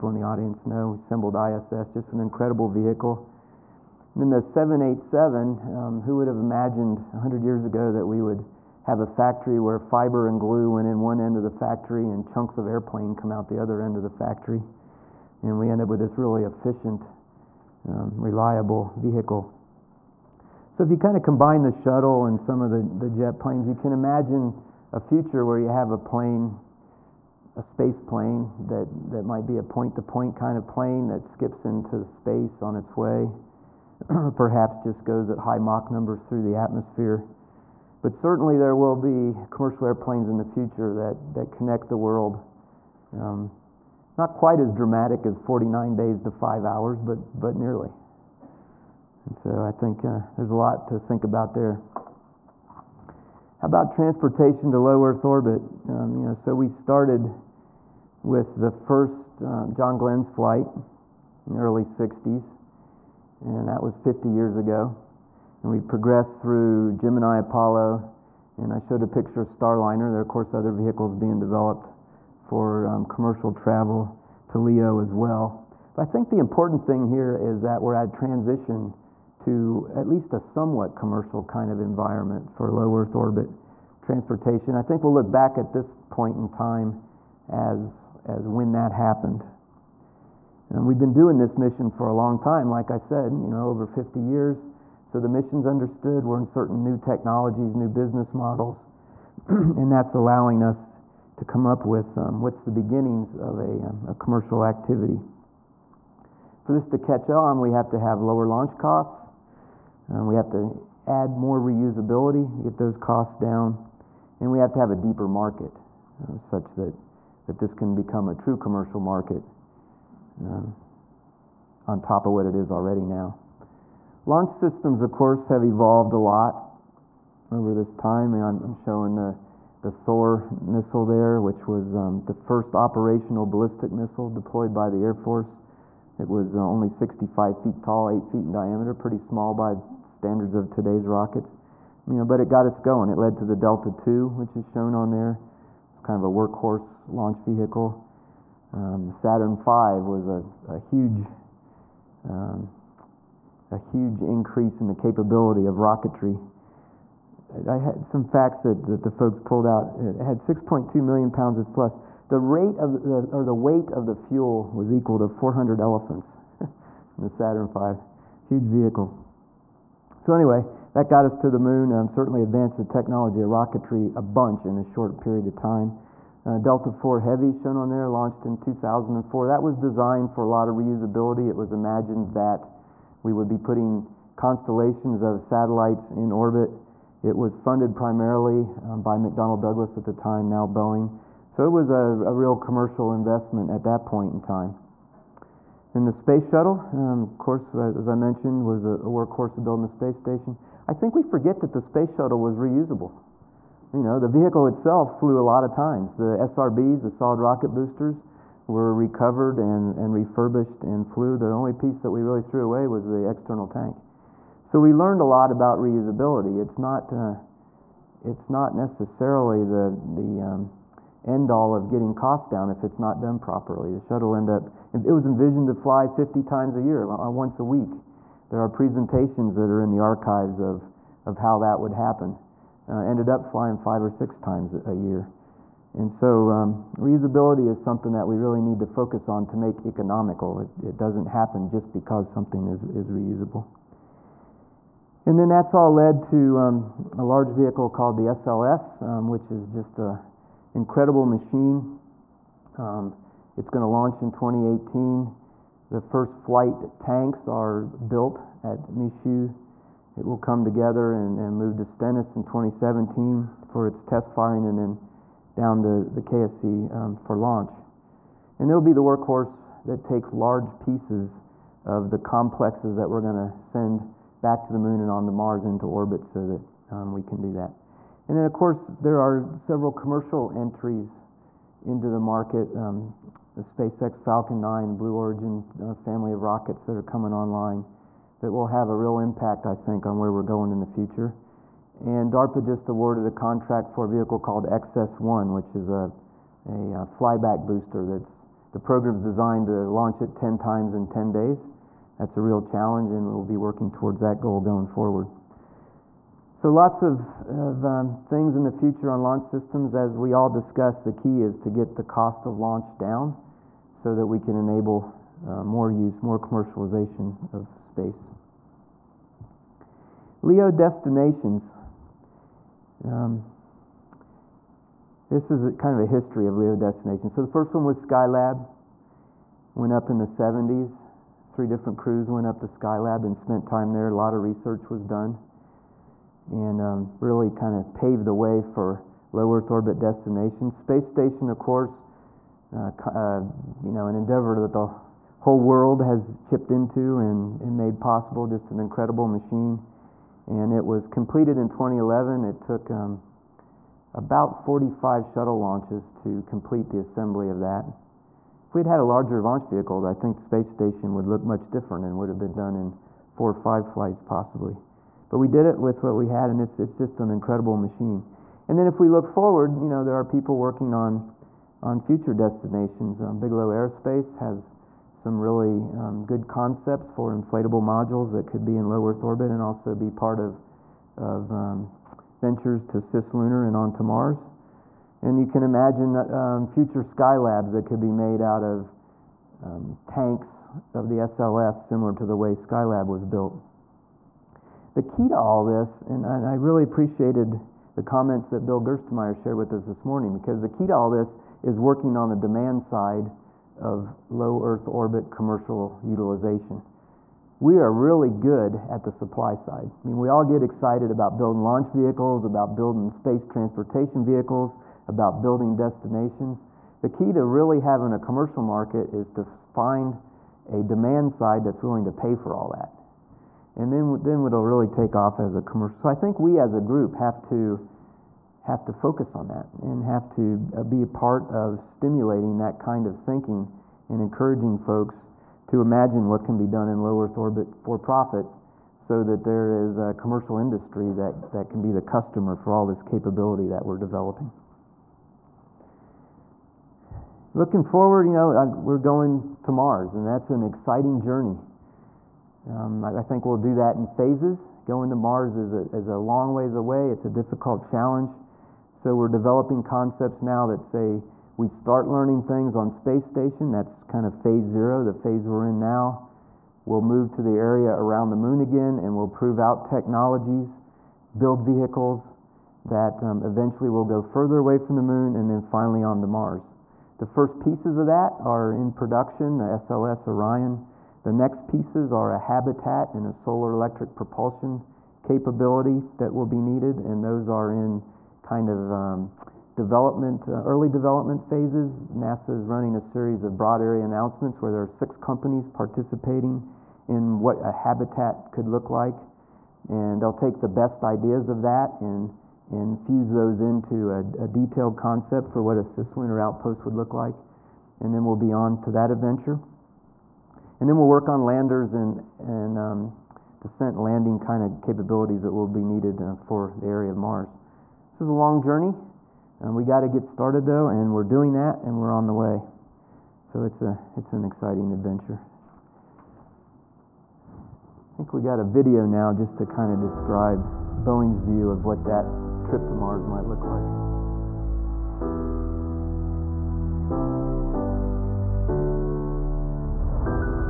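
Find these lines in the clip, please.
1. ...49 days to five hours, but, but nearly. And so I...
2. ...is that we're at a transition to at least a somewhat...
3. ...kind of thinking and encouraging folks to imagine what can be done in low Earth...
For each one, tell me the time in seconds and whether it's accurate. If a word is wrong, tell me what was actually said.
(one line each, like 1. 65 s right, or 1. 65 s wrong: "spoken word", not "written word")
1. 45 s right
2. 77 s right
3. 432 s right.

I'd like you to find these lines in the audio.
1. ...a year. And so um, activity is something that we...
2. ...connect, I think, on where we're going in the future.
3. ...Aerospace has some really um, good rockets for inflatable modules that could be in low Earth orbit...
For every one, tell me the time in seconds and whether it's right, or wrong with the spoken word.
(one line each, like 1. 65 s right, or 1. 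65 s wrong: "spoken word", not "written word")
1. 234 s wrong: "reusability", not "activity"
2. 289 s wrong: "impact", not "connect"
3. 373 s wrong: "concepts", not "rockets".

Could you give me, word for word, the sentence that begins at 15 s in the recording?
And we end up with this really efficient, um, reliable vehicle.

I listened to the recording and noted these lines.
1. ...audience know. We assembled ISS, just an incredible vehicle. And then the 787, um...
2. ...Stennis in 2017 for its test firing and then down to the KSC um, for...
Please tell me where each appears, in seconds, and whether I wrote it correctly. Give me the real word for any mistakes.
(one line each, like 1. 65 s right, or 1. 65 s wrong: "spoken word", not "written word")
1. 0 s right
2. 261 s right.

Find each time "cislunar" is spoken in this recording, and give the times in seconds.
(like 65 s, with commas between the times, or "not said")
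382 s, 505 s.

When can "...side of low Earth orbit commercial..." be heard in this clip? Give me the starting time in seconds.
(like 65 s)
402 s.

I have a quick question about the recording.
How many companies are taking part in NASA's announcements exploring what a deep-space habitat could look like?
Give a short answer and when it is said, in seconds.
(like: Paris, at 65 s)
6, at 494 s.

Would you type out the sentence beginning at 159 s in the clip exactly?
It had 6.2 million pounds of flesh.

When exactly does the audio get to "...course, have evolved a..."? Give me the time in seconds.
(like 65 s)
125 s.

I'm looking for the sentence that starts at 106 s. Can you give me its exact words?
For this to catch on, we have to have lower launch costs.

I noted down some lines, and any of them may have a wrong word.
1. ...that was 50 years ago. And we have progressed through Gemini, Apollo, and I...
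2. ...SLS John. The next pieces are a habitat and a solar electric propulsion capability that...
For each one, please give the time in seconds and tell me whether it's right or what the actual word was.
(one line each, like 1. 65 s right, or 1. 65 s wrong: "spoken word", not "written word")
1. 63 s right
2. 479 s wrong: "Orion", not "John".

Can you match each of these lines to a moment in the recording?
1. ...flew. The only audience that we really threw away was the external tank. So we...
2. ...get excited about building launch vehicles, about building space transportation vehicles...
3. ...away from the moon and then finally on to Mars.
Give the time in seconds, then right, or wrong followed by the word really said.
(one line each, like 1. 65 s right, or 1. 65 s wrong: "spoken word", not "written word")
1. 211 s wrong: "piece", not "audience"
2. 410 s right
3. 474 s right.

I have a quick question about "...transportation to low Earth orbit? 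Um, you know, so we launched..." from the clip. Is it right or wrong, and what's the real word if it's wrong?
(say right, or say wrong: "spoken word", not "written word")
wrong: "started", not "launched".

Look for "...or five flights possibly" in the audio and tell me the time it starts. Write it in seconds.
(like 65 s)
363 s.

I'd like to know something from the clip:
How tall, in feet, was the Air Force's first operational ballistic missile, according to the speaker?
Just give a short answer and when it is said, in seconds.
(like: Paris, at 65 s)
65 feet, at 136 s.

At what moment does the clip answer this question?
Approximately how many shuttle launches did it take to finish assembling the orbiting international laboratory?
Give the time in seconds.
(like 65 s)
354 s.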